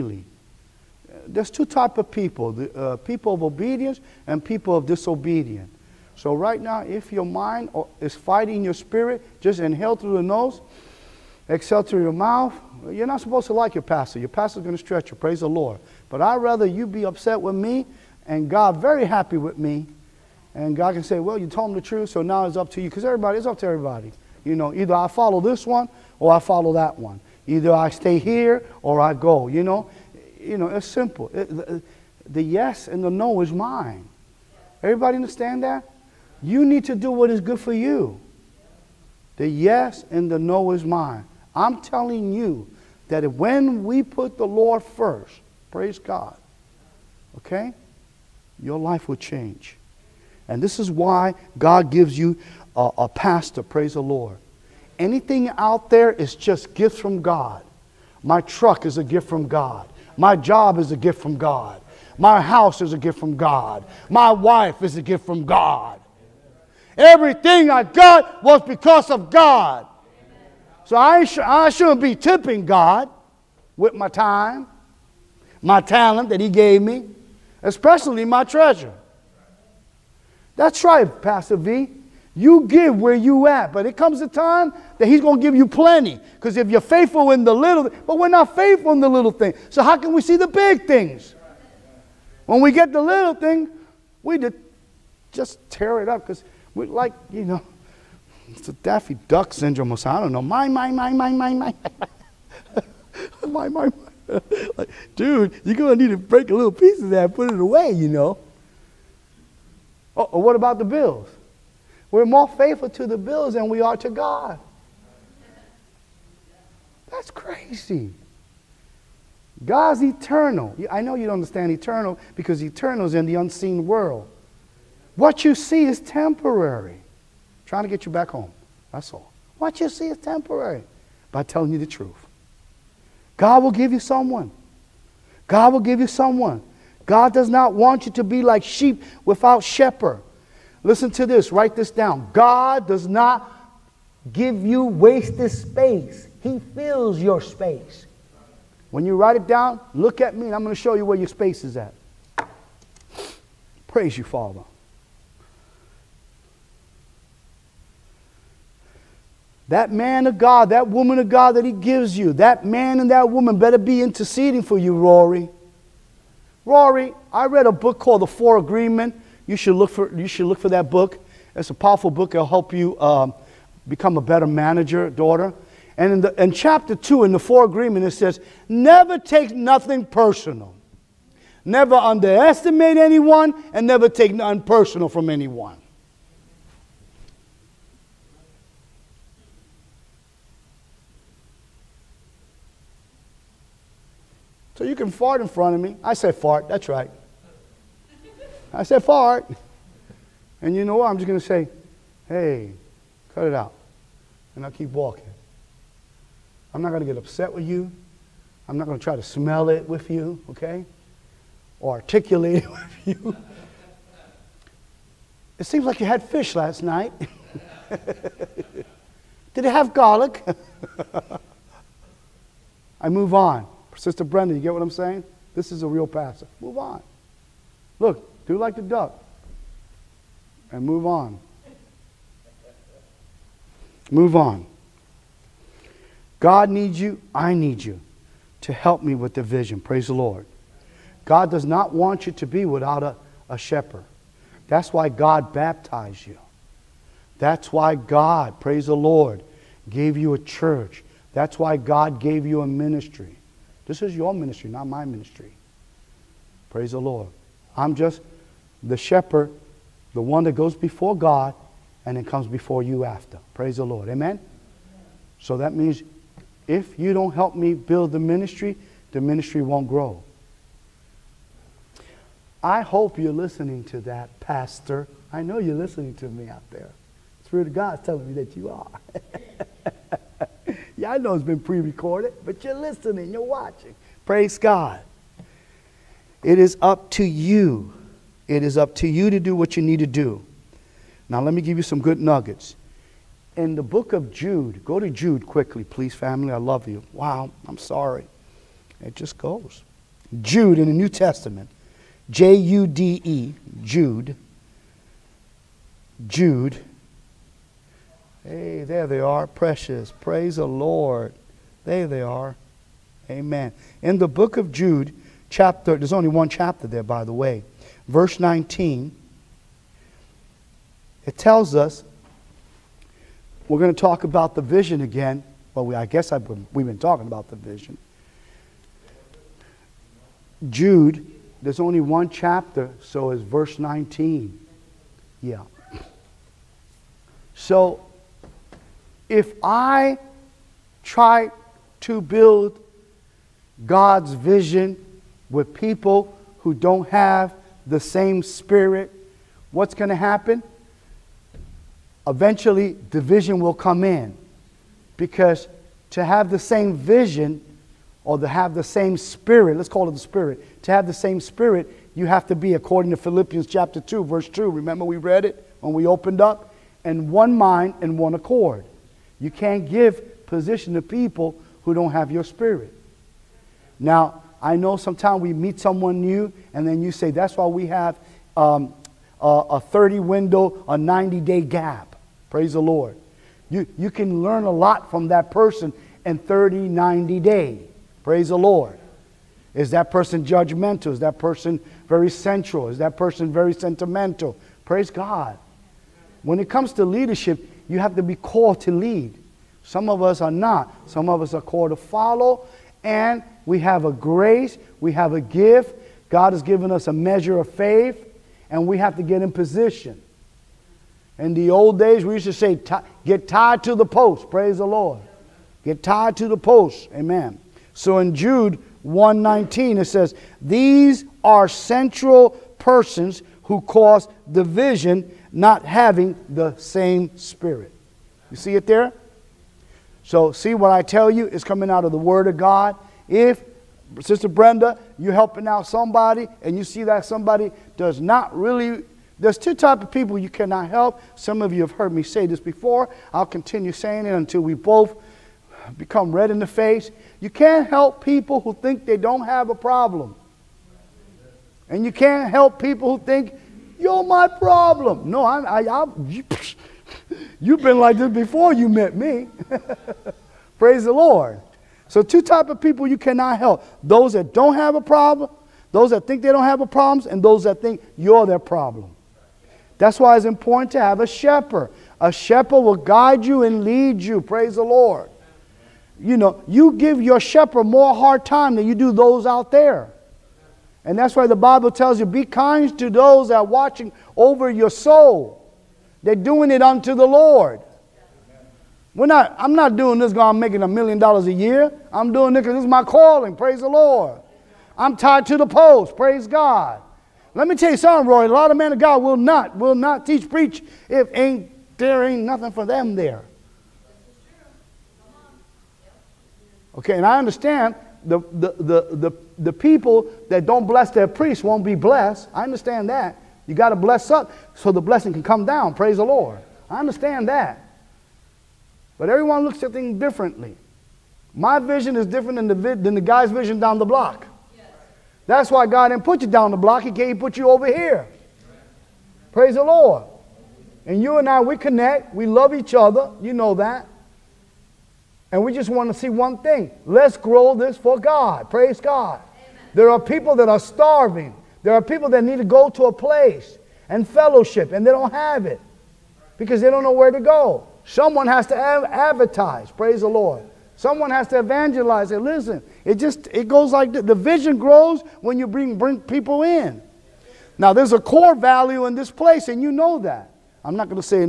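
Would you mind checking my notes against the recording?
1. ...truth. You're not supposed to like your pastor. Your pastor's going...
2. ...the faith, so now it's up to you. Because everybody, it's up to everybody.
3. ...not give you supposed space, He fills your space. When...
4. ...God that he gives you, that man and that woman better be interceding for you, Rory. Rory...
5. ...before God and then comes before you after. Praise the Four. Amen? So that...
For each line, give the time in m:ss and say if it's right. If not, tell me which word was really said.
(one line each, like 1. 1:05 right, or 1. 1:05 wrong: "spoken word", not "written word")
1. 0:12 wrong: "mouth", not "truth"
2. 0:21 wrong: "truth", not "faith"
3. 2:23 wrong: "wasted", not "supposed"
4. 2:41 right
5. 4:20 wrong: "Lord", not "Four".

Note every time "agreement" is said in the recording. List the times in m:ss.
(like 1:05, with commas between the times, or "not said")
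2:48, 2:57.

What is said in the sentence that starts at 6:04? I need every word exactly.
Remember, we read it when we opened up?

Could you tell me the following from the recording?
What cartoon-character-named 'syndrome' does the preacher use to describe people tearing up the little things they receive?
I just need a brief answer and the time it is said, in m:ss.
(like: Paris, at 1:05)
Daffy Duck syndrome, at 1:38.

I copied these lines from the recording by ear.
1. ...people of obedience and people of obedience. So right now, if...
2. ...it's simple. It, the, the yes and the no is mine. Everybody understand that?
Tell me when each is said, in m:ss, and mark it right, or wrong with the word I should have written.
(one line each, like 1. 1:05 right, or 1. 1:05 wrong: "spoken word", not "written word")
1. 0:02 wrong: "disobedience", not "obedience"
2. 0:30 right.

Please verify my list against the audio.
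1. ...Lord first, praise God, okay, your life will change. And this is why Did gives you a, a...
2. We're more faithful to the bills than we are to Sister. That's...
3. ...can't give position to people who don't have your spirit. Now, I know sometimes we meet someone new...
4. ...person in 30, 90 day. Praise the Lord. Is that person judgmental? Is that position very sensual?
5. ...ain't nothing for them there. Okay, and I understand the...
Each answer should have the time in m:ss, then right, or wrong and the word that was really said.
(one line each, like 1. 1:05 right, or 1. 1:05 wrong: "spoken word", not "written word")
1. 0:44 wrong: "God", not "Did"
2. 1:52 wrong: "God", not "Sister"
3. 6:09 right
4. 6:25 wrong: "person", not "position"
5. 8:22 right.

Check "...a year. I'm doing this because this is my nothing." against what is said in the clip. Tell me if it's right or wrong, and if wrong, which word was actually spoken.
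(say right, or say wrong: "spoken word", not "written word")
wrong: "calling", not "nothing".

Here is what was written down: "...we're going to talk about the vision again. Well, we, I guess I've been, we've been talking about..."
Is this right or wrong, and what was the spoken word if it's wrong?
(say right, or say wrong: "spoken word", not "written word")
right.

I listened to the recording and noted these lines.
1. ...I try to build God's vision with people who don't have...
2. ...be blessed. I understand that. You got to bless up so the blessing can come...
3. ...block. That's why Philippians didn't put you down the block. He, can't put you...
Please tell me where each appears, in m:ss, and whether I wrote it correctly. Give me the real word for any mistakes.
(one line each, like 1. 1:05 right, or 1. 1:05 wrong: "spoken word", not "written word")
1. 5:39 right
2. 8:31 right
3. 8:44 wrong: "God", not "Philippians".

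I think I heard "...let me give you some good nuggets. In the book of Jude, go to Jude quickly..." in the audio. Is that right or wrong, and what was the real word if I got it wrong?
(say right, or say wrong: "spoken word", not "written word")
right.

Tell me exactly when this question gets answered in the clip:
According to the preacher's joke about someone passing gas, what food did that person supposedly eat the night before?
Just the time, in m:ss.
3:36.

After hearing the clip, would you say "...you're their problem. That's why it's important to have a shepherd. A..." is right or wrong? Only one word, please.
right.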